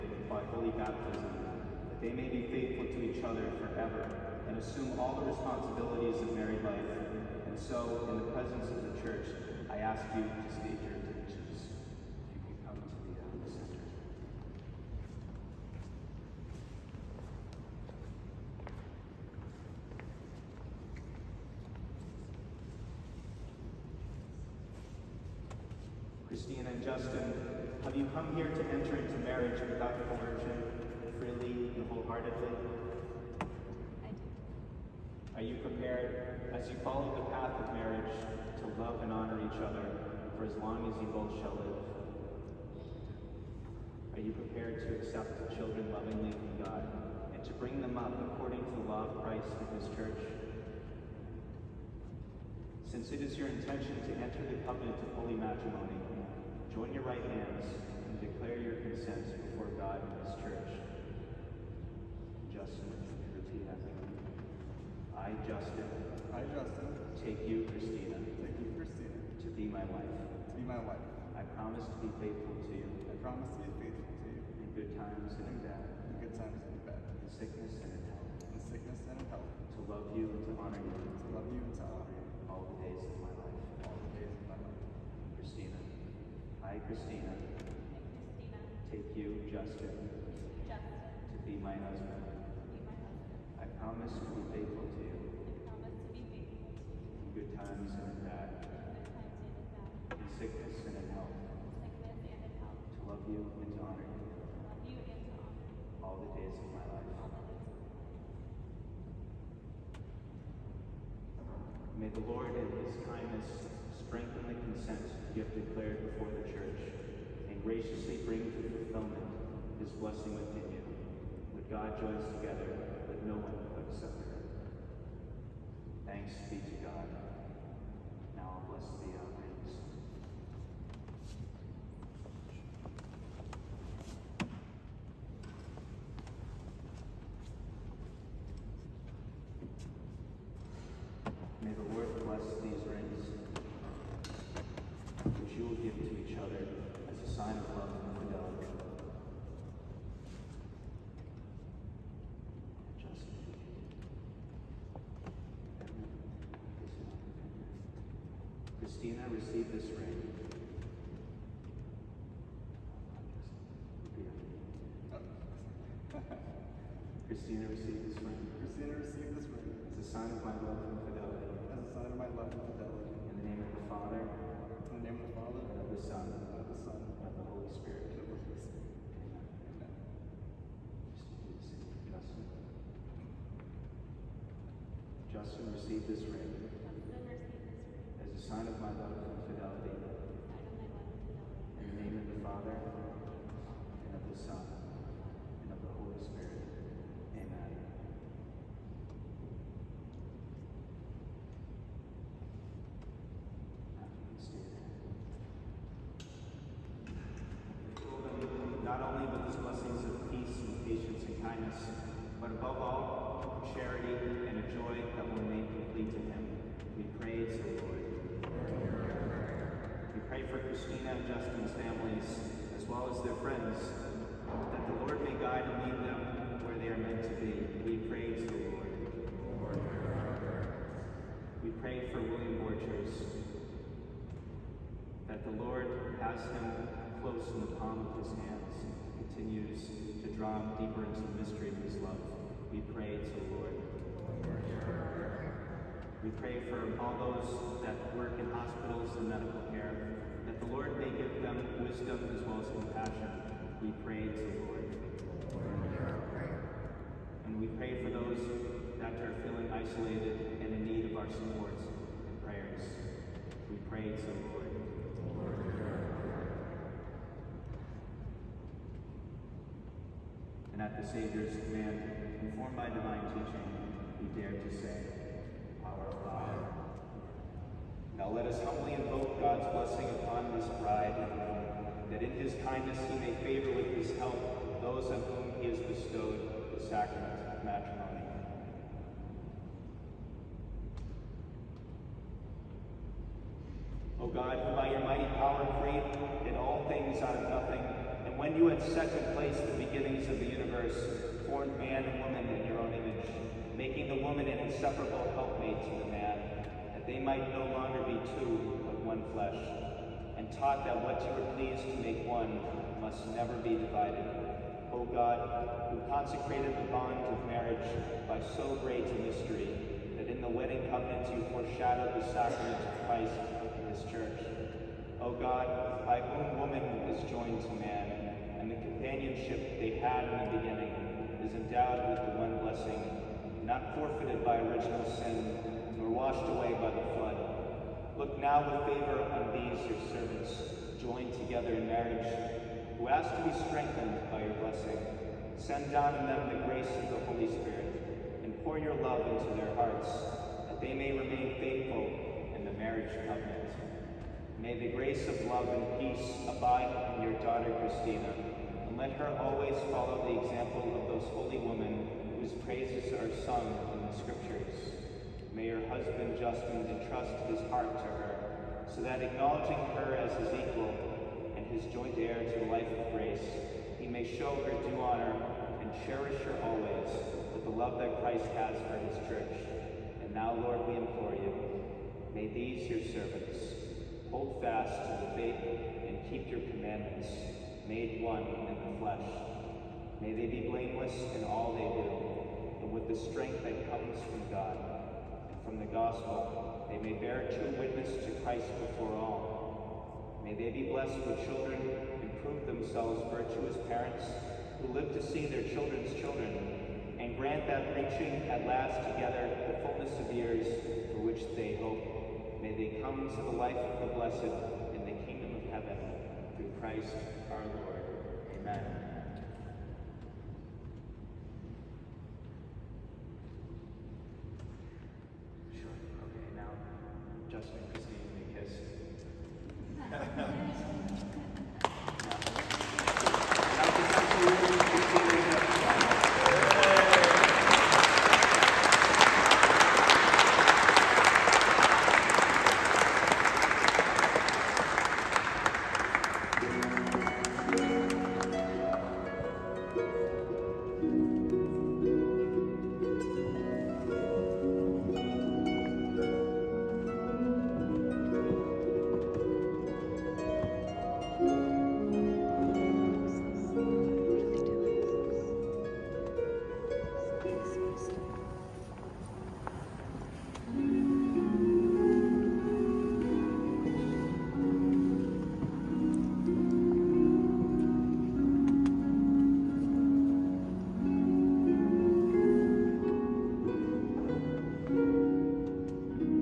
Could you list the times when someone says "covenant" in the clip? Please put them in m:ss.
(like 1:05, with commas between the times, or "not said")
0:54, 5:20, 5:53.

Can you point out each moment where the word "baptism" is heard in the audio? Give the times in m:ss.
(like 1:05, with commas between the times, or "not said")
0:00.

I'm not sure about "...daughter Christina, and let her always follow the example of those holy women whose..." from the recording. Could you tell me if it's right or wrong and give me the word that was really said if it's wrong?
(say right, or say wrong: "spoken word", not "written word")
right.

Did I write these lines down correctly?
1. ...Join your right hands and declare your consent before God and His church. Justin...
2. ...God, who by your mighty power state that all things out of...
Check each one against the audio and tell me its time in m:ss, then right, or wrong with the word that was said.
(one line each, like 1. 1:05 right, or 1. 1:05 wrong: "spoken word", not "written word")
1. 0:56 right
2. 4:54 wrong: "create", not "state".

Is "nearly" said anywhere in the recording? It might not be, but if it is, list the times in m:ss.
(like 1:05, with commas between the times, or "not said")
not said.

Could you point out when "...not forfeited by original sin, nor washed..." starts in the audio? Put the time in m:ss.
5:33.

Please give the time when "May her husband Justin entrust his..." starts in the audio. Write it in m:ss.
6:05.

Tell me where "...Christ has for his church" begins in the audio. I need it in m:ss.
6:18.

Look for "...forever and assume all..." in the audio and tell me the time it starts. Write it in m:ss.
0:03.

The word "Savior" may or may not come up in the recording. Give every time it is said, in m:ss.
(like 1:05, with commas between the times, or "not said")
4:31.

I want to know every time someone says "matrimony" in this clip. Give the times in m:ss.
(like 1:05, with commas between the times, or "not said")
0:55, 4:47.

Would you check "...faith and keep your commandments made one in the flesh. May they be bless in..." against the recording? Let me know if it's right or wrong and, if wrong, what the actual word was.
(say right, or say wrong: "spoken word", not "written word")
wrong: "blameless", not "bless".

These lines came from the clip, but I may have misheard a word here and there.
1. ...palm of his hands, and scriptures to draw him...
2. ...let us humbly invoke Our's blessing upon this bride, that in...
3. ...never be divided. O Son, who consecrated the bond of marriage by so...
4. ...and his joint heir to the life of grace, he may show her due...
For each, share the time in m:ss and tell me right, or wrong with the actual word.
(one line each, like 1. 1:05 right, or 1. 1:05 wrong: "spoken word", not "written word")
1. 3:57 wrong: "continues", not "scriptures"
2. 4:38 wrong: "God", not "Our"
3. 5:13 wrong: "God", not "Son"
4. 6:11 right.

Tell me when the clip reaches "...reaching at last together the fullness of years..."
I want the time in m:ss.
6:47.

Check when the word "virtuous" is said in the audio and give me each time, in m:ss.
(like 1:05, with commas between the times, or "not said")
6:43.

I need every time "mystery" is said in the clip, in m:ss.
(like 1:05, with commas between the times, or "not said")
4:01, 5:19.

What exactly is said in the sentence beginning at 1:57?
graciously bring to fulfillment his blessing within you.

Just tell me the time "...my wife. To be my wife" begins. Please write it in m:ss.
1:09.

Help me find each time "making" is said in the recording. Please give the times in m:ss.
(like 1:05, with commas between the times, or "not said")
5:03.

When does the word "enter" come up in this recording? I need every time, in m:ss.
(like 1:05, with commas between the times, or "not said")
0:28, 0:54.